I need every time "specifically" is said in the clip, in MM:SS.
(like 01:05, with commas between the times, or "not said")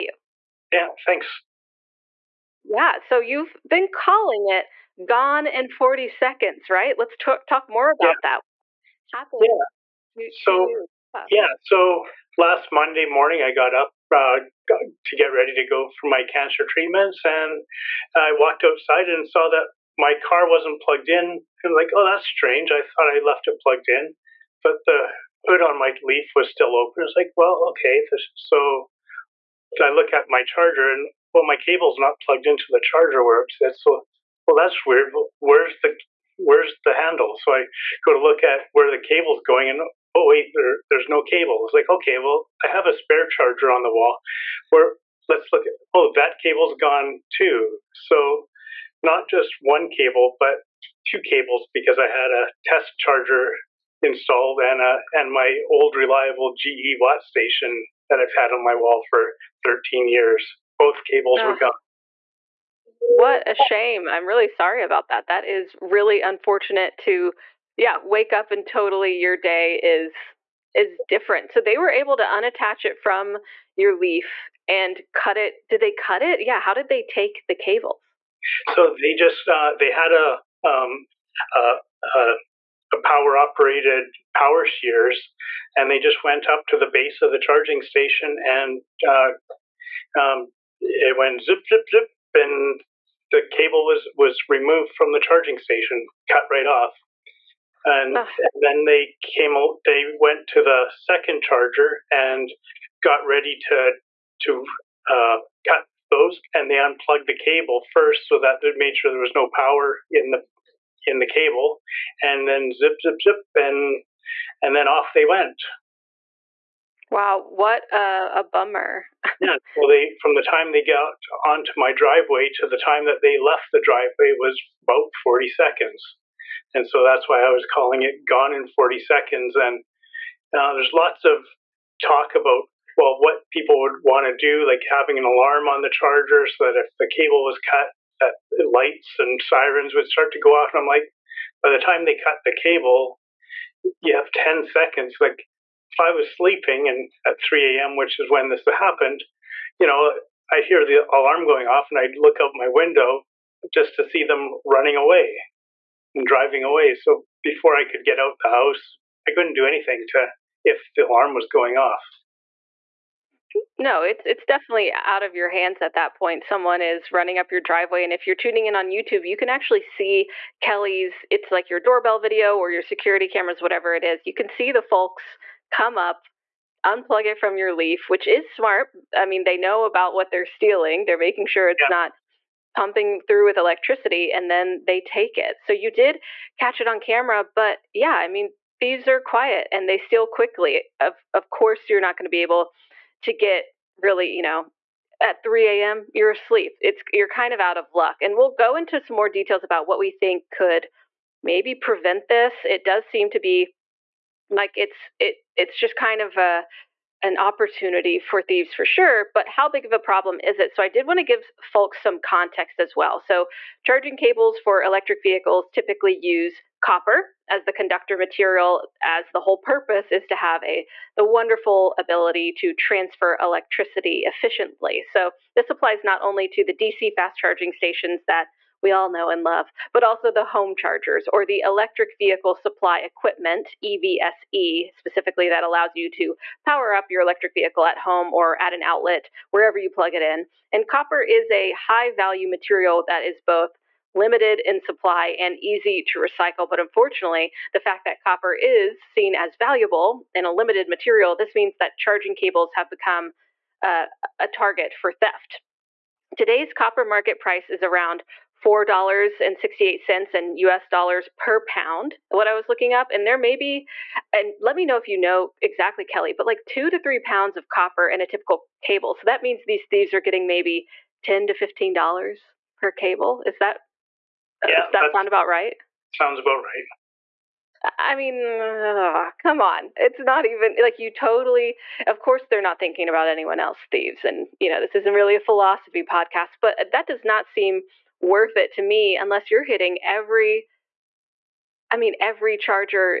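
03:54.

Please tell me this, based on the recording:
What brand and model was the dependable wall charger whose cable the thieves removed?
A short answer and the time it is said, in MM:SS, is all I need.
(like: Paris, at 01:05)
GE WattStation, at 00:56.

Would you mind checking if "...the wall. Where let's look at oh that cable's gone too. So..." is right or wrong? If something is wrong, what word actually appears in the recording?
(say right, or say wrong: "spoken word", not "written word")
right.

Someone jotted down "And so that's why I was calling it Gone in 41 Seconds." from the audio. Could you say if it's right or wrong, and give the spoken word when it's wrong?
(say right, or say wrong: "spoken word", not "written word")
wrong: "40", not "41".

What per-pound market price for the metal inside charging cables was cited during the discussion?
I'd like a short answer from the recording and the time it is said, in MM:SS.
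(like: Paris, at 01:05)
$4.68, at 04:18.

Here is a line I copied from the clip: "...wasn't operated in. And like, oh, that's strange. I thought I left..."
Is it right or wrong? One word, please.
wrong.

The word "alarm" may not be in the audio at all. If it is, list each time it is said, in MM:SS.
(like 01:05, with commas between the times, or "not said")
02:15, 02:31, 02:41.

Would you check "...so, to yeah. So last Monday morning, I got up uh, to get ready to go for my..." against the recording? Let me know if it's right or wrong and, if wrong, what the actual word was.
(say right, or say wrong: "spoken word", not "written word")
right.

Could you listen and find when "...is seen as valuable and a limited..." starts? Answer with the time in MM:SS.
04:08.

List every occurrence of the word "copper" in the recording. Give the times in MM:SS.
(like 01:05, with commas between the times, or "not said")
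03:36, 04:00, 04:08, 04:16, 04:27.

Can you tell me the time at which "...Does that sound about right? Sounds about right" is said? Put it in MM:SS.
04:34.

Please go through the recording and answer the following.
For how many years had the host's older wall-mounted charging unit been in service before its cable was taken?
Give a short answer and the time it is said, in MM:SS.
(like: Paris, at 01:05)
13, at 00:59.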